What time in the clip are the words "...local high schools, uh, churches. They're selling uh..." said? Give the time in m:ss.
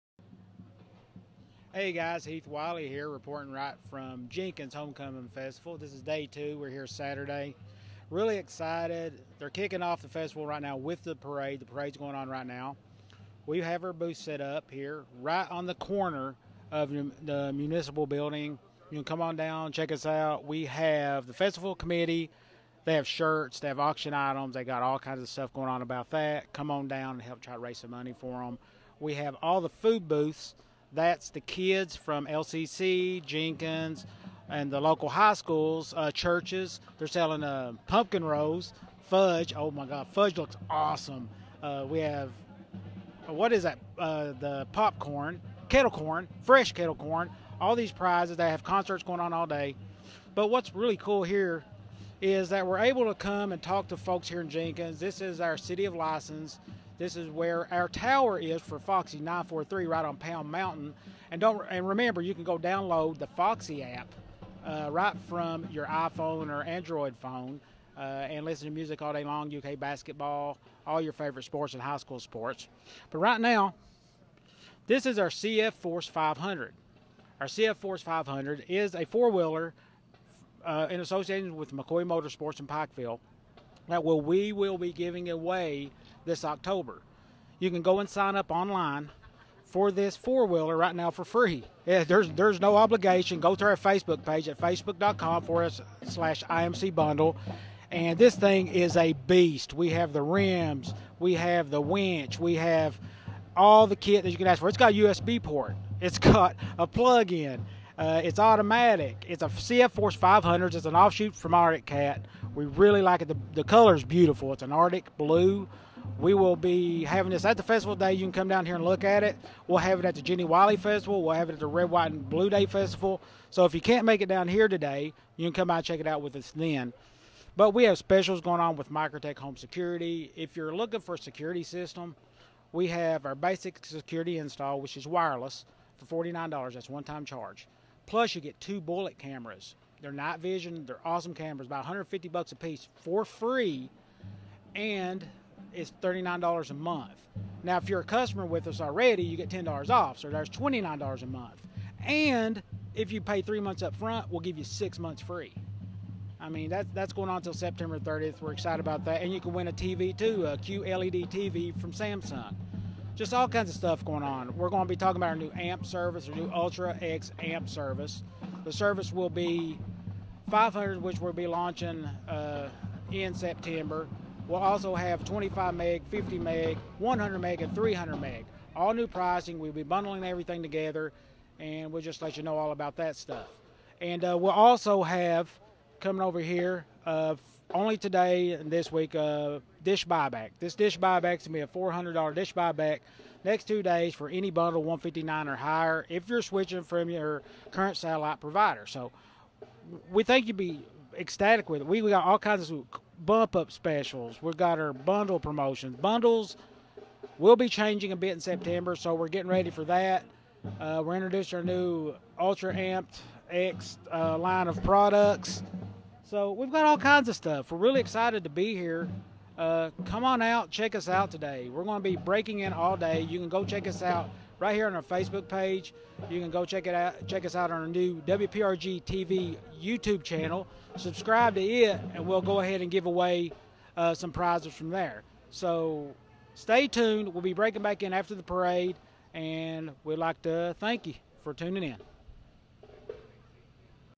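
0:34.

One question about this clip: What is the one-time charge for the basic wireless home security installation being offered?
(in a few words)
$49.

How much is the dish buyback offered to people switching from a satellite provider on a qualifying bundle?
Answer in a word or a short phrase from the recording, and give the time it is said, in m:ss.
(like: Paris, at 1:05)
$400, at 3:11.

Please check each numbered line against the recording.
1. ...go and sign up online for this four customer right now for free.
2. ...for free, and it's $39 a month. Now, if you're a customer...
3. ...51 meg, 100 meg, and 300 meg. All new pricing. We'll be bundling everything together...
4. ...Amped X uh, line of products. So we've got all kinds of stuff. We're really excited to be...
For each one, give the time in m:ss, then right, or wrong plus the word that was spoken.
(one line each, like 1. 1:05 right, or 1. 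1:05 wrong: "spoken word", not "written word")
1. 1:27 wrong: "wheeler", not "customer"
2. 2:22 right
3. 2:56 wrong: "50", not "51"
4. 3:32 right.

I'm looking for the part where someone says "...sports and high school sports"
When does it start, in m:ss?
1:11.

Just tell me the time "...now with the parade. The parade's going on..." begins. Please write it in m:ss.
0:10.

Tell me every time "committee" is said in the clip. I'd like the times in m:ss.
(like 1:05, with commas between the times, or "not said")
0:21.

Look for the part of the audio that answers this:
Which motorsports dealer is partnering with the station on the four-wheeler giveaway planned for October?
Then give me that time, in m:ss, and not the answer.
1:21.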